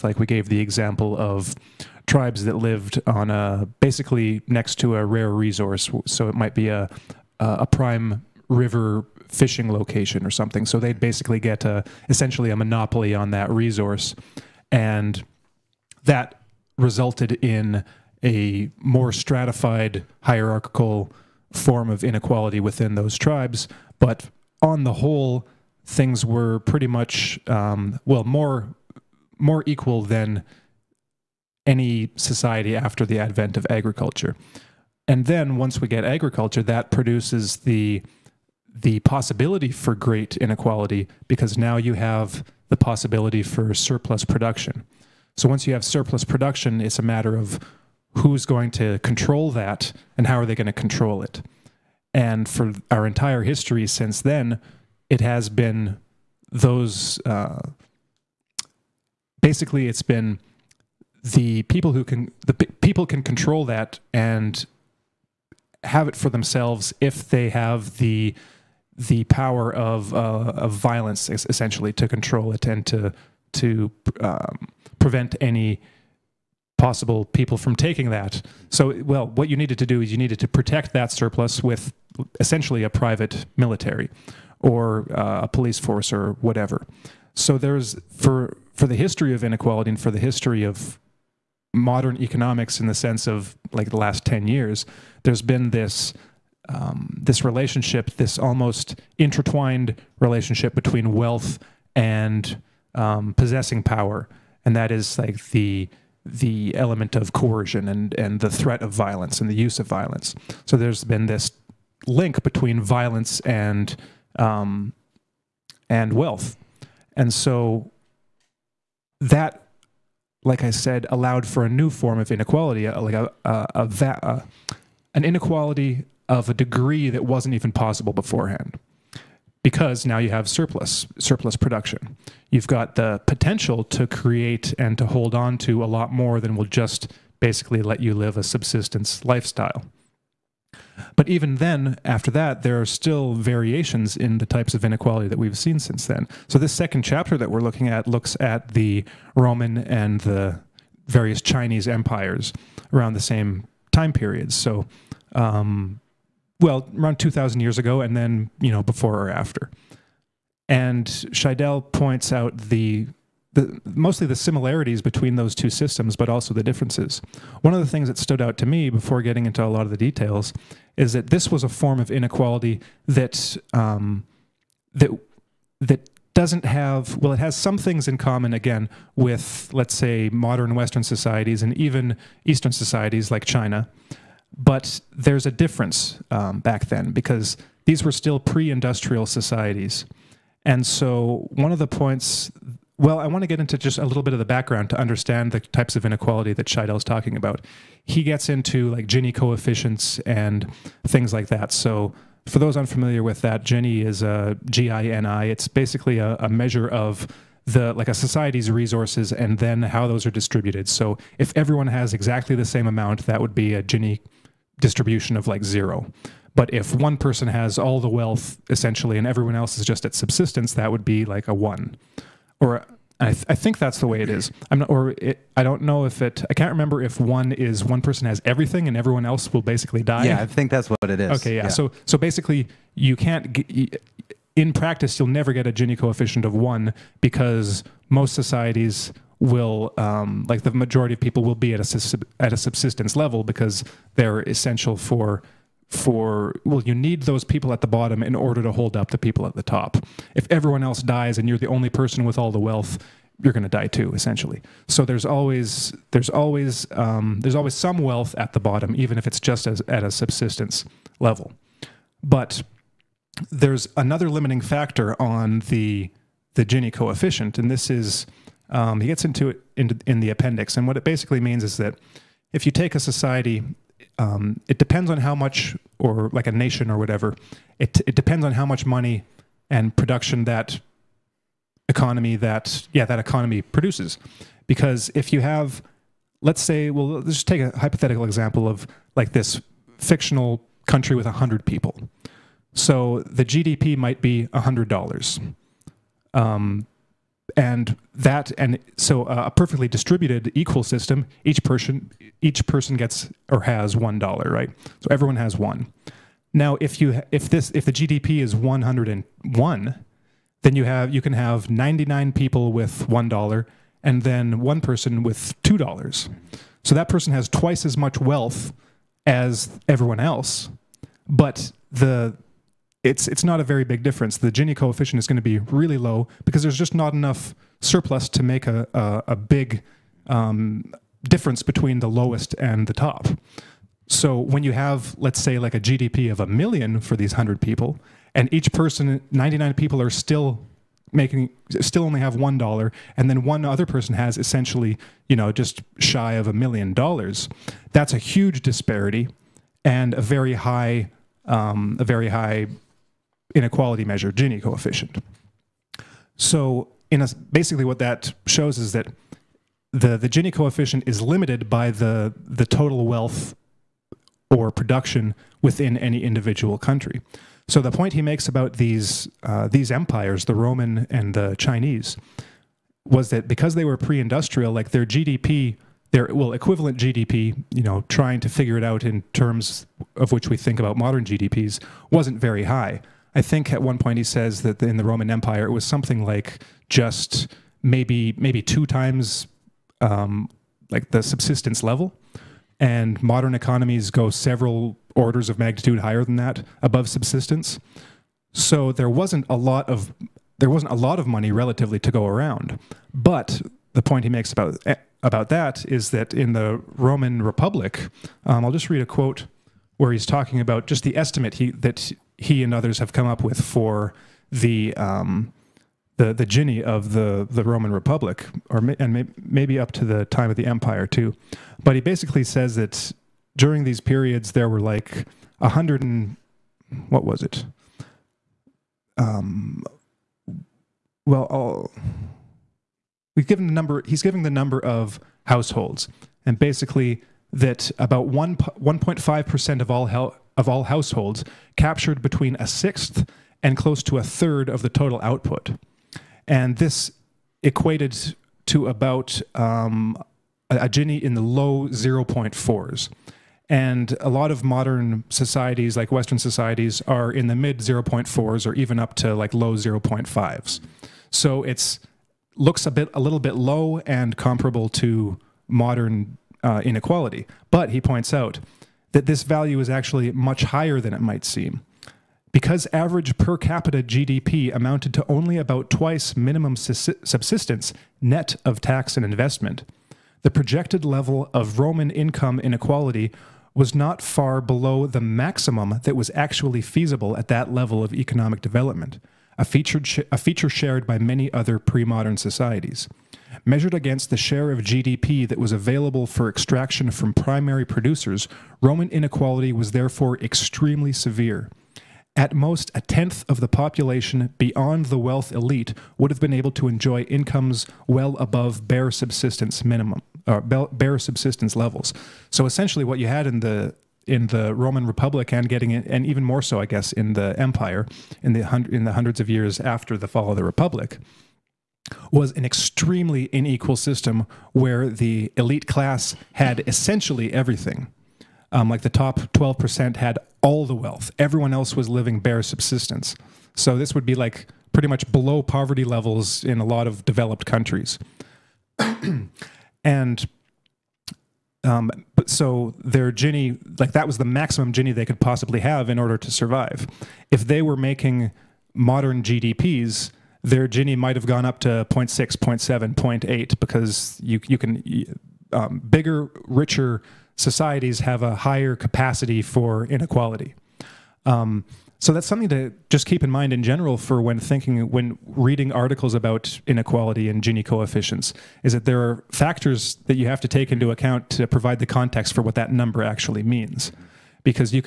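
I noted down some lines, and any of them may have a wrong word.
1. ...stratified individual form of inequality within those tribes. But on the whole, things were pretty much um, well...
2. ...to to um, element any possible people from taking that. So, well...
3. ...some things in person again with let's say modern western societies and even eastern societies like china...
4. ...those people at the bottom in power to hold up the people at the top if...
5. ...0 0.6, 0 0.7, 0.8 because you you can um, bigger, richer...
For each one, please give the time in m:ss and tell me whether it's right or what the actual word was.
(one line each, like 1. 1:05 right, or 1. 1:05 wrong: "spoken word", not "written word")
1. 0:19 wrong: "hierarchical", not "individual"
2. 1:12 wrong: "prevent", not "element"
3. 2:57 wrong: "common", not "person"
4. 4:07 wrong: "order", not "power"
5. 9:11 right.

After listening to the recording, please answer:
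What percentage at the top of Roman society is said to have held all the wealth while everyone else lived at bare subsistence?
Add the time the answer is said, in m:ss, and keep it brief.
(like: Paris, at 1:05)
12%, at 8:49.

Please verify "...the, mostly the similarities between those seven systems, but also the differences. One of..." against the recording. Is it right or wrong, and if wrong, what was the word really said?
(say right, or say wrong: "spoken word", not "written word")
wrong: "two", not "seven".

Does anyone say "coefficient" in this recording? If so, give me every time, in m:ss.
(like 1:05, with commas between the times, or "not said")
3:19, 3:55, 4:26, 5:24, 5:54, 6:00, 9:27.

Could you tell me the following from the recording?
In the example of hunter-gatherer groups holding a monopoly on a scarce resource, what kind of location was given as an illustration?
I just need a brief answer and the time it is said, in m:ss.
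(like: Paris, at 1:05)
Prime river fishing location, at 0:07.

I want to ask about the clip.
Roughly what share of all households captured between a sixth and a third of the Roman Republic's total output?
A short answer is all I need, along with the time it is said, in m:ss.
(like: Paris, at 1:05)
1.5%, at 7:18.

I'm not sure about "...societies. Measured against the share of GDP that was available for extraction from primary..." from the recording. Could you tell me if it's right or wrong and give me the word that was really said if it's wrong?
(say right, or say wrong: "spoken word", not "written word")
right.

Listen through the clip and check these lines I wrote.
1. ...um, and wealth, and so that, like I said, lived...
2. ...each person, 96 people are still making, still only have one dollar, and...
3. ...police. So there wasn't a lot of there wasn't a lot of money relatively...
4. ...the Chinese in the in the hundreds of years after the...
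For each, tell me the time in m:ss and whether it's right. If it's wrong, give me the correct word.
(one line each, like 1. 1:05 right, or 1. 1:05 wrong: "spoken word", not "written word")
1. 1:54 wrong: "allowed", not "lived"
2. 5:38 wrong: "99", not "96"
3. 6:37 wrong: "subsistence", not "police"
4. 8:37 wrong: "Empire", not "Chinese".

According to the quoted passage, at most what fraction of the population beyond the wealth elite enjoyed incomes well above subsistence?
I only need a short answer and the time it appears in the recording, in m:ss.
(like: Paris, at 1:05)
A tenth, at 8:22.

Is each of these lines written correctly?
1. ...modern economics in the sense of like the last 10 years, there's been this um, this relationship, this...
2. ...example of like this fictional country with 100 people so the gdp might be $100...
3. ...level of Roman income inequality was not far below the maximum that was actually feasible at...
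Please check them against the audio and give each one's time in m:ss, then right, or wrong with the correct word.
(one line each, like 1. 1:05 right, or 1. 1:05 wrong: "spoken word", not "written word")
1. 1:31 right
2. 4:48 right
3. 8:01 right.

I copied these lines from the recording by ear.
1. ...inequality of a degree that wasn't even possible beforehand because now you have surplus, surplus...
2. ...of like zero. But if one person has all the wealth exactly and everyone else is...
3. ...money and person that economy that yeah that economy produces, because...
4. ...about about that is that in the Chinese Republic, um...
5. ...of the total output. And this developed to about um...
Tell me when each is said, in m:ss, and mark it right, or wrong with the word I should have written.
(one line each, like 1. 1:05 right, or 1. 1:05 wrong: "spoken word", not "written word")
1. 2:05 right
2. 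3:35 wrong: "essentially", not "exactly"
3. 4:38 wrong: "production", not "person"
4. 6:44 wrong: "Roman", not "Chinese"
5. 7:24 wrong: "equated", not "developed".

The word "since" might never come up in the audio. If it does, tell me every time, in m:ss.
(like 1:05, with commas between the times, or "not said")
0:53, 2:25.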